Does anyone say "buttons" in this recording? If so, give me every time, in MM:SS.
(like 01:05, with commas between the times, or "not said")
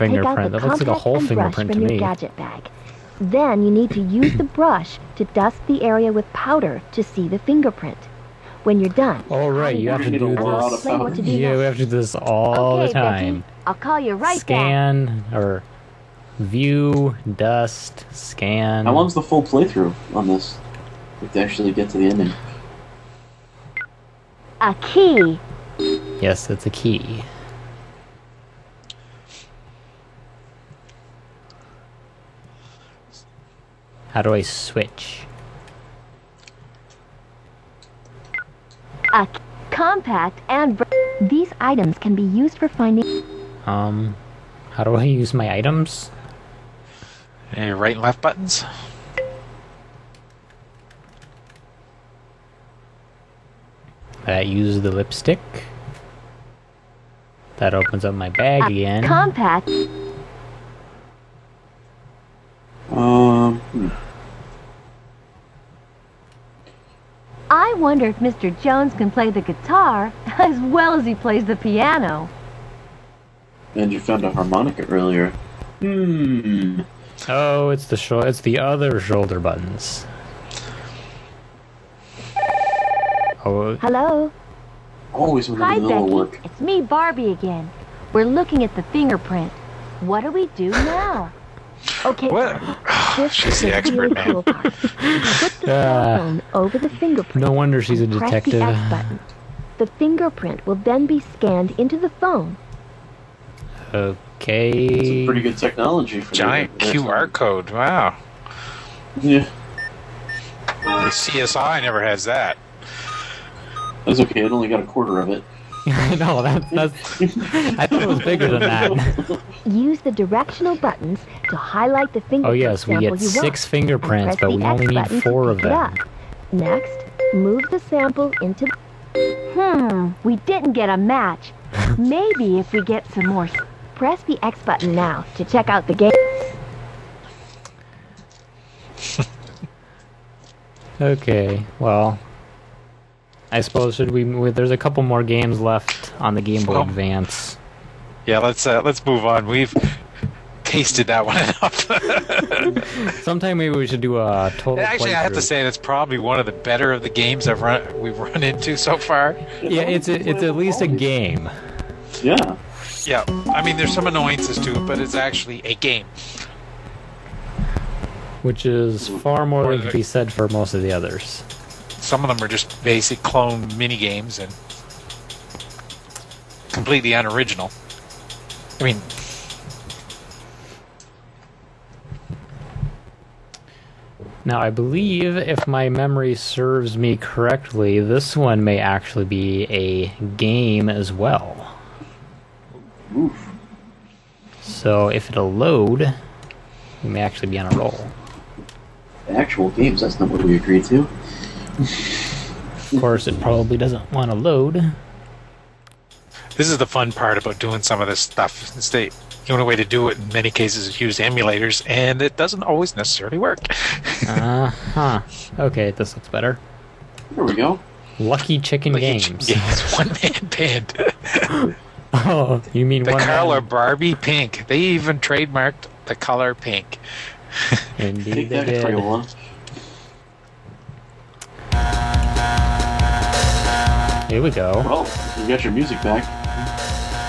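00:48, 01:19, 01:38, 02:00, 02:14.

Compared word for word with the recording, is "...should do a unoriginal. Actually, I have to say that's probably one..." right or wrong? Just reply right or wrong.
wrong.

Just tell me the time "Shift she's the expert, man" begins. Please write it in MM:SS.
01:33.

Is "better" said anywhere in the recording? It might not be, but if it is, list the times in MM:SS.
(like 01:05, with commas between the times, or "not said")
02:36, 03:36.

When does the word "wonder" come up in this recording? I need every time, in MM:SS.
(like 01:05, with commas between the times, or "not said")
01:08, 01:37.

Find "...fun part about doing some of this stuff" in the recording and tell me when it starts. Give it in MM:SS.
03:26.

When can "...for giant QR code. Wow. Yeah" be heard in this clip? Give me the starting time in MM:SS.
01:46.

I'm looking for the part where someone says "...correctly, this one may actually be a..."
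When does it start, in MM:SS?
03:07.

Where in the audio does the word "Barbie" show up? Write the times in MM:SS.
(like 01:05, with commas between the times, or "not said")
01:26, 03:43.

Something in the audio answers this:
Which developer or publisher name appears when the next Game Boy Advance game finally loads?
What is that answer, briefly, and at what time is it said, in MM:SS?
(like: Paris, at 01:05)
Lucky Chicken, at 03:38.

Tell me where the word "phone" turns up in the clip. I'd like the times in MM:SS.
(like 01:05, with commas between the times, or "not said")
01:36, 01:42.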